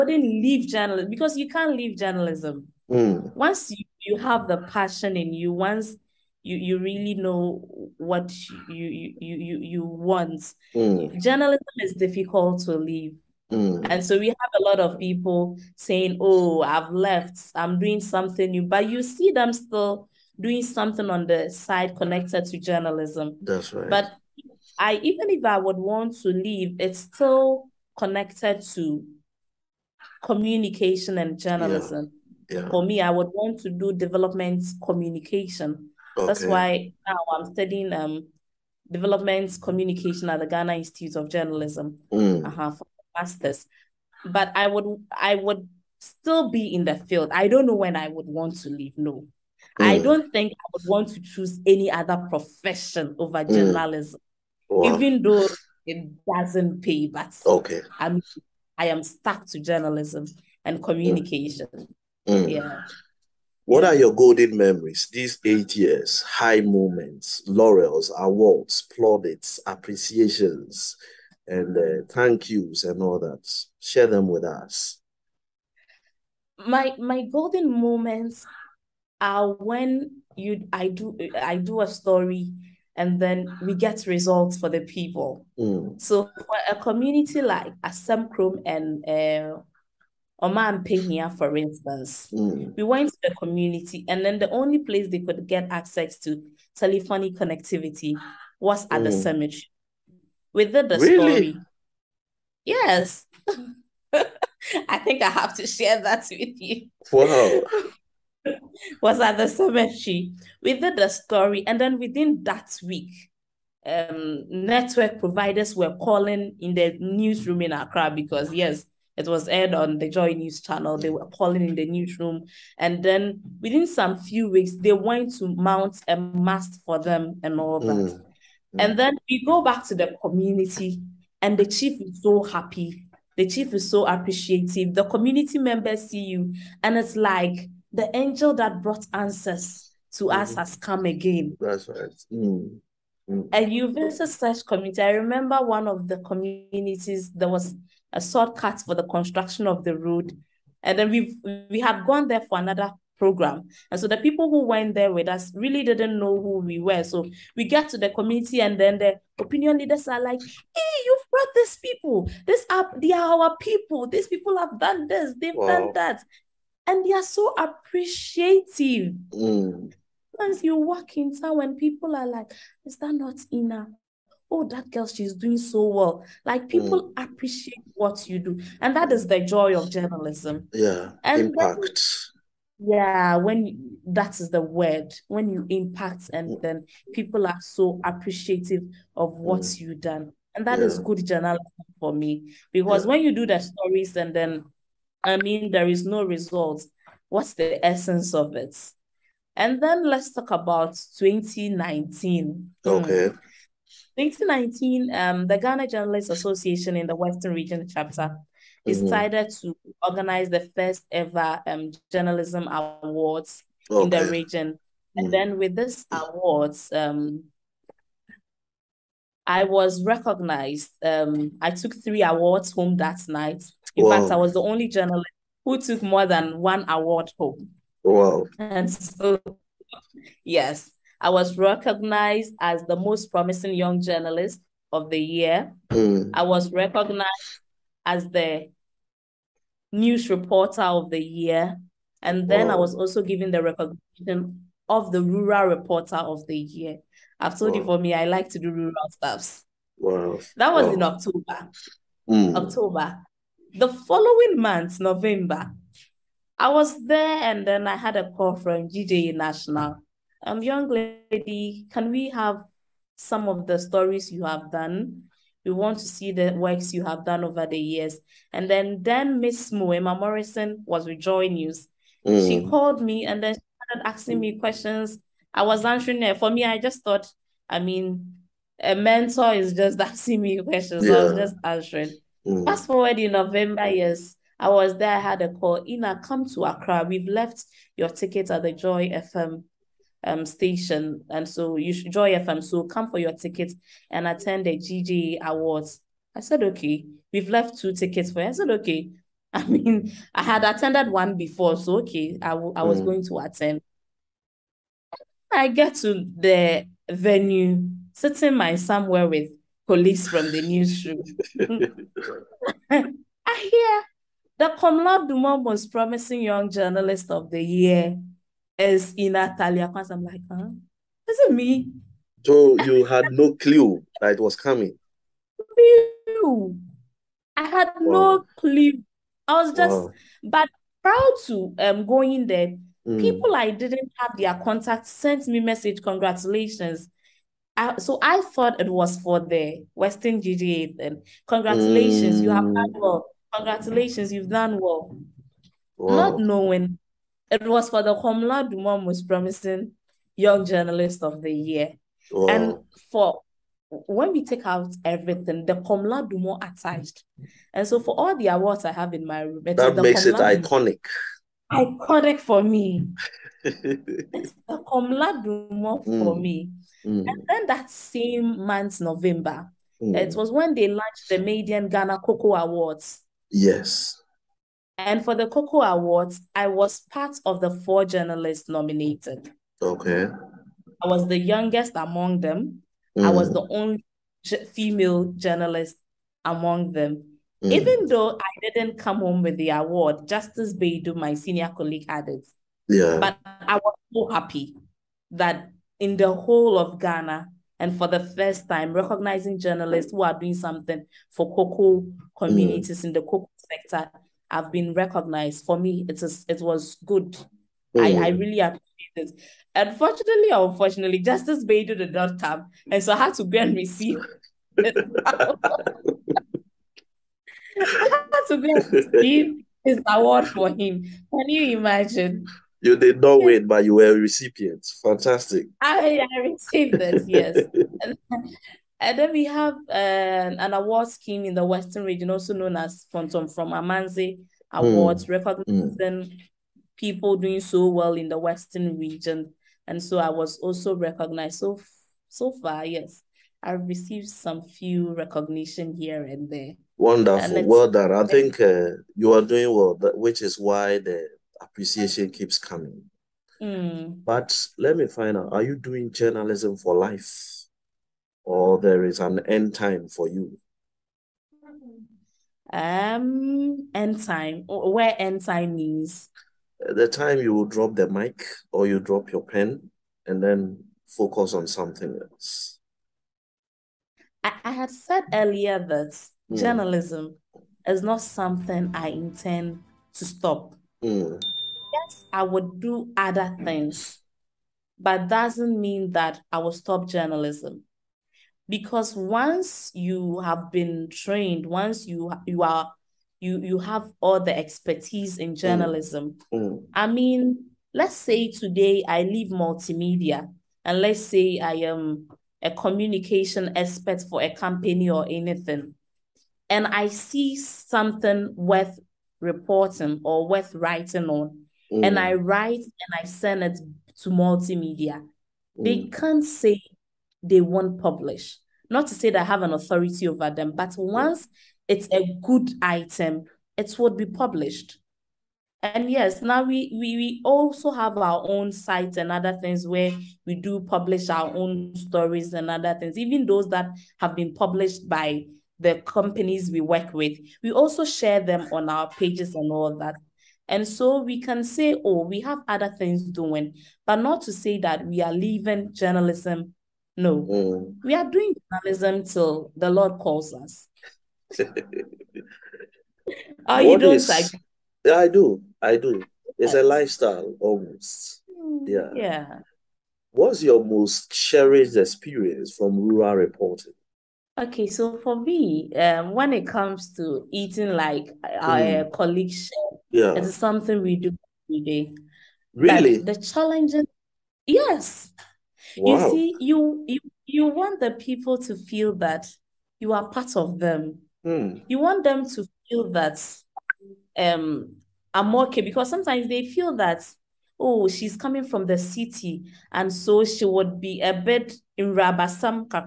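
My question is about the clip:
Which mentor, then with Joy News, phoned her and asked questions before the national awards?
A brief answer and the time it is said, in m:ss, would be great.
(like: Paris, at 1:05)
Moema Morrison, at 4:29.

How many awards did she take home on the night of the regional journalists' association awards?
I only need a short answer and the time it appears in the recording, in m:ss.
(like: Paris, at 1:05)
3, at 3:42.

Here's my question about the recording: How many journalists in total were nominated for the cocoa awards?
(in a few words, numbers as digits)
4.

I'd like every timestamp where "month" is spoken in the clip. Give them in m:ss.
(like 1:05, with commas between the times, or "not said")
4:14, 6:08.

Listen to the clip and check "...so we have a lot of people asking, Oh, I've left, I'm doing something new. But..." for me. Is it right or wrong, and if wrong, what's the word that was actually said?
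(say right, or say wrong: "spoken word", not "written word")
wrong: "saying", not "asking".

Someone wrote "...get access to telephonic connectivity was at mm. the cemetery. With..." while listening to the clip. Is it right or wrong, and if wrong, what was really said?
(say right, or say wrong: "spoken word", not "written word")
right.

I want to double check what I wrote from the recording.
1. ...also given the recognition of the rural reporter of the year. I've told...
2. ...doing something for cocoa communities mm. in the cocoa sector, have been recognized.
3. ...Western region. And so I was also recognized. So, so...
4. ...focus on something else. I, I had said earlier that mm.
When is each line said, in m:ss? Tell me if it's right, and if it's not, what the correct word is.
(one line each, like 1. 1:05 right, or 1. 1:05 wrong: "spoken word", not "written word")
1. 4:02 right
2. 6:40 right
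3. 7:18 right
4. 7:51 right.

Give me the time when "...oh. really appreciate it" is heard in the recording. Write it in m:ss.
6:48.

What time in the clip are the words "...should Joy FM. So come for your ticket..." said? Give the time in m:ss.
4:51.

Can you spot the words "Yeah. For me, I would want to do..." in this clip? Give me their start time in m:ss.
0:32.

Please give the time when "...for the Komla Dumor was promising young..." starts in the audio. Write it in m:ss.
5:47.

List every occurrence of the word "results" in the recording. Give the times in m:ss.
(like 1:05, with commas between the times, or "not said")
1:24, 3:16.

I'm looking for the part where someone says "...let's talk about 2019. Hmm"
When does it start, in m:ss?
3:20.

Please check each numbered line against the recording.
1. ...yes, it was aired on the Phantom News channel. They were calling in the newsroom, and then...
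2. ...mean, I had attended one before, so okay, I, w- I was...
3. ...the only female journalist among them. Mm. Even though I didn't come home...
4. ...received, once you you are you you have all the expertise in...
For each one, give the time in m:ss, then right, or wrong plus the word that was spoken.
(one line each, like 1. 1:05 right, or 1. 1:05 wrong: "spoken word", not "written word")
1. 1:58 wrong: "Joy", not "Phantom"
2. 4:59 right
3. 6:23 right
4. 8:11 wrong: "trained", not "received".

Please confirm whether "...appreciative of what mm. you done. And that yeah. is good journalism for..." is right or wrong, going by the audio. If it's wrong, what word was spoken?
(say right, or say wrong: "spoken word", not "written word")
right.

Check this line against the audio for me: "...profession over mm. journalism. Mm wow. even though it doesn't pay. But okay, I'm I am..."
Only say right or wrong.
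right.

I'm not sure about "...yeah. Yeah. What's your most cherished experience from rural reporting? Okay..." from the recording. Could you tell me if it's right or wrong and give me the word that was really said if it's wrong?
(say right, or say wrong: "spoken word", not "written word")
right.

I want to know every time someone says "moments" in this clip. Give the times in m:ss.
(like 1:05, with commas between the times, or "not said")
1:06, 1:17.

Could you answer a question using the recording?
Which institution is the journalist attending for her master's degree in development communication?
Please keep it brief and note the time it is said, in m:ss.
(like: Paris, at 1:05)
Ghana Institute of Journalism, at 0:40.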